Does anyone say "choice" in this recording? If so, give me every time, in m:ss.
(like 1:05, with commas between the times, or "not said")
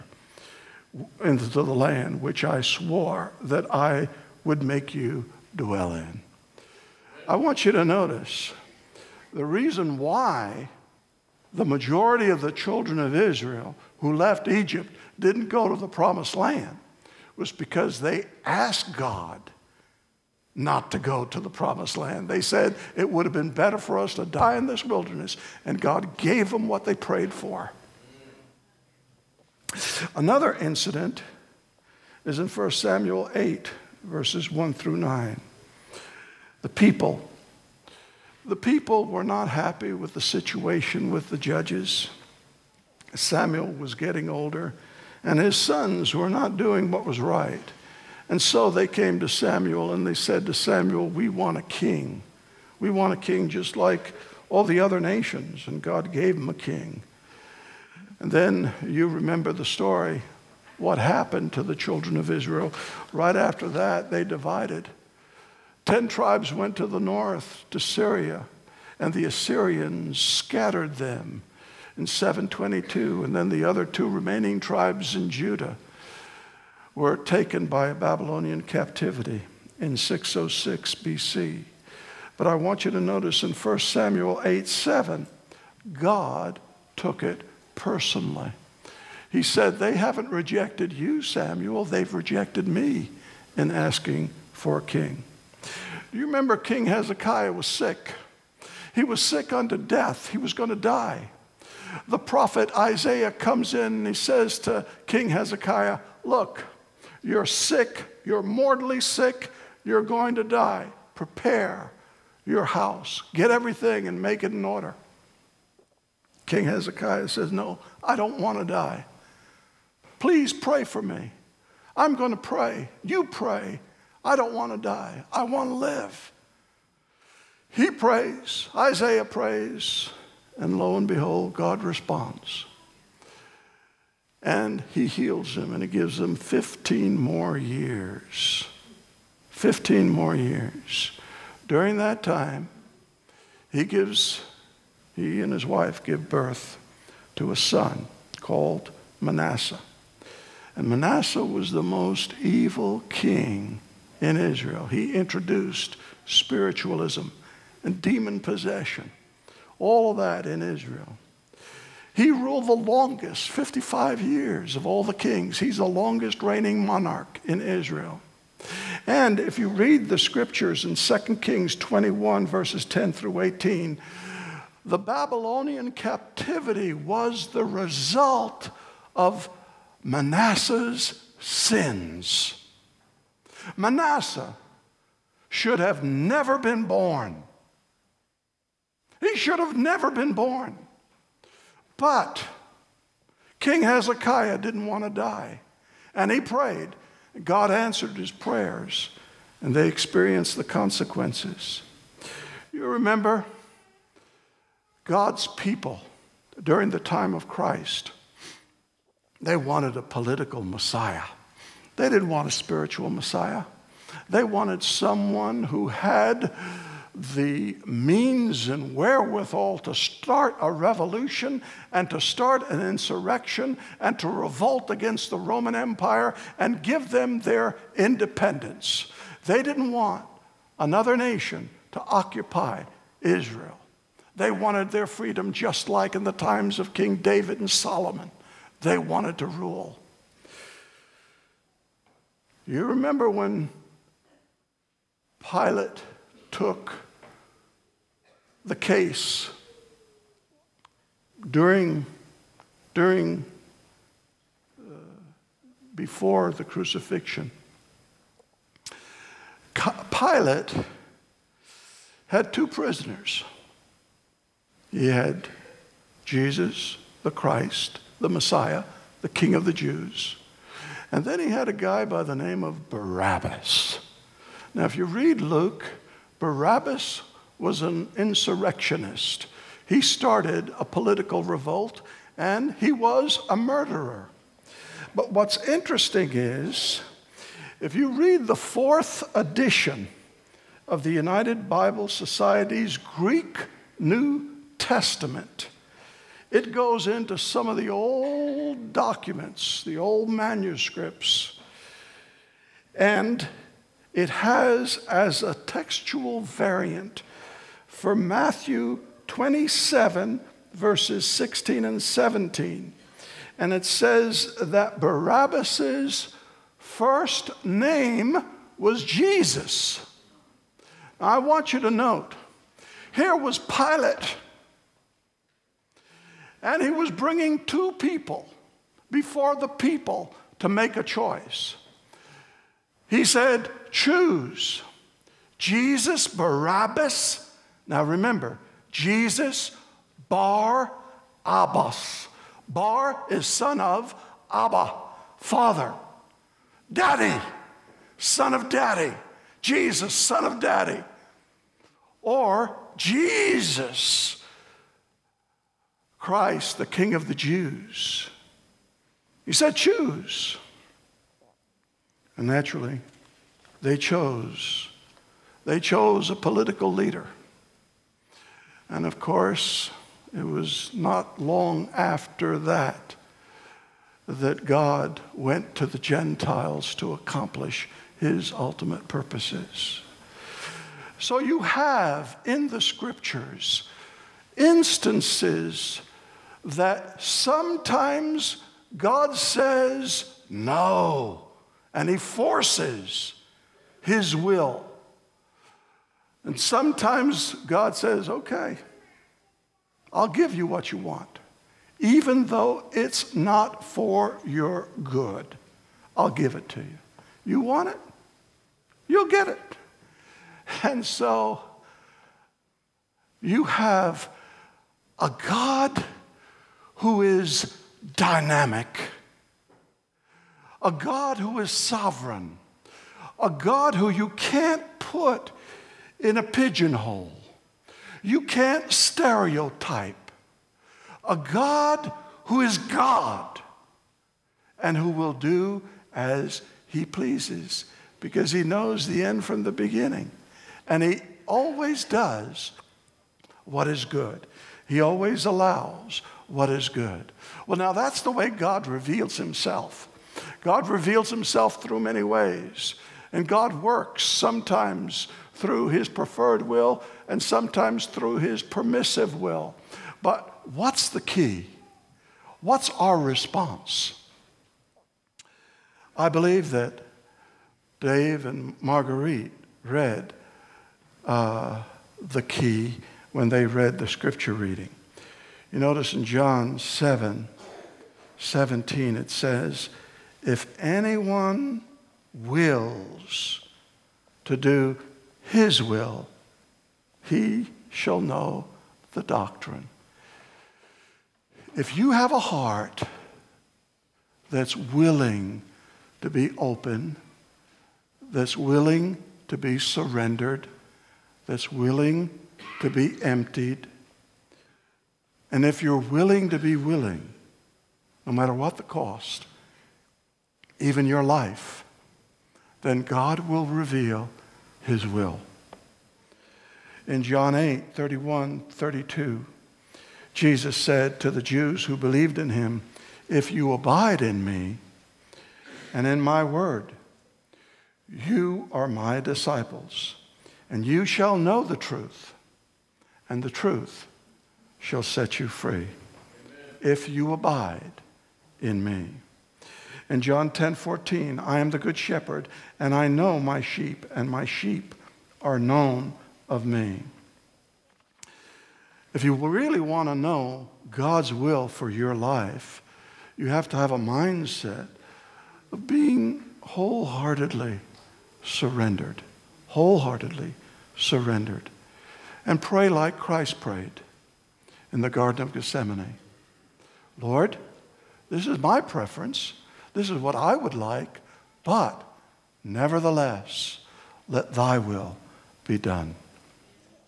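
5:31.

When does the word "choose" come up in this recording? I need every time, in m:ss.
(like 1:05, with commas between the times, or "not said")
5:33, 5:59.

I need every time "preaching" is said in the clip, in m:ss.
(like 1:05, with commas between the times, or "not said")
not said.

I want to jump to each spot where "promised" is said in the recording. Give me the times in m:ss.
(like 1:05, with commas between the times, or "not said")
0:15, 0:21.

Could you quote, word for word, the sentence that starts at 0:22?
They said it would have been better for us to die in this wilderness, and God gave them what they prayed for.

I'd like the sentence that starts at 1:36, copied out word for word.
Do you remember King Hezekiah was sick?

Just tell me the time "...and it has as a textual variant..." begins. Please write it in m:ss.
5:02.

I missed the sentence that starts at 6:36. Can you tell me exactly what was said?
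And sometimes God says, okay, I'll give you what you want, even though it's not for your good.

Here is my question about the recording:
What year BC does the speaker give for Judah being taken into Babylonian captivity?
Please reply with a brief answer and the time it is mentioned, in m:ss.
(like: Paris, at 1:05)
606 BC, at 1:19.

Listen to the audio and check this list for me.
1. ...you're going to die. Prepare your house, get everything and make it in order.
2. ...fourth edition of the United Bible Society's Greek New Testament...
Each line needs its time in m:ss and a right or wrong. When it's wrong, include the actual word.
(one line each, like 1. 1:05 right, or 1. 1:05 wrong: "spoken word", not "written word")
1. 1:49 right
2. 4:48 right.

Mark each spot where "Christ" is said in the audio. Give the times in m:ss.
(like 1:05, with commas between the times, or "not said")
3:27, 4:27, 5:56, 9:23.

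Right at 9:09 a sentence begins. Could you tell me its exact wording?
If you really want to know God's will for your life, you have to have a mindset of being wholeheartedly surrendered.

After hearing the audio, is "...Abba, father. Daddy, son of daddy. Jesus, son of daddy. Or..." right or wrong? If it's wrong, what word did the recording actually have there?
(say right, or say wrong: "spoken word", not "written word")
right.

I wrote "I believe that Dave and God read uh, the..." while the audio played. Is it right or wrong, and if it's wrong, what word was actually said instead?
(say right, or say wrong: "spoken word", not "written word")
wrong: "Marguerite", not "God".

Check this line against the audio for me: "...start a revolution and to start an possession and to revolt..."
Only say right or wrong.
wrong.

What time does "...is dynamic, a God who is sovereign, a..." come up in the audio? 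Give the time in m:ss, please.
6:57.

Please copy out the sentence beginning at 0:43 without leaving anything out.
Samuel was getting older, and his sons were not doing what was right.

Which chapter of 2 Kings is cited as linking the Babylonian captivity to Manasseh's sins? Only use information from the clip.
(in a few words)
21.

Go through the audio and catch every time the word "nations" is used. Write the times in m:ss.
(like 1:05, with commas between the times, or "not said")
0:55, 3:51.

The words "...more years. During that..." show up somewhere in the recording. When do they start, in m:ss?
2:20.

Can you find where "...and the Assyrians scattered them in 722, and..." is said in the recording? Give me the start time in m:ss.
1:08.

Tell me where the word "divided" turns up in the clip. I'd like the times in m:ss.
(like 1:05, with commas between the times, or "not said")
1:04.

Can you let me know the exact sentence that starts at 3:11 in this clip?
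But King Hezekiah didn't want to die, and he prayed.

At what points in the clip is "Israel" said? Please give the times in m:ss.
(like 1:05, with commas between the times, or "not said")
0:13, 1:02, 2:34, 2:40, 2:47, 3:53.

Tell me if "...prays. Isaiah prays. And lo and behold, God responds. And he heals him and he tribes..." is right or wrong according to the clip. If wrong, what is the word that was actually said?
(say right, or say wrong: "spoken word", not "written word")
wrong: "gives", not "tribes".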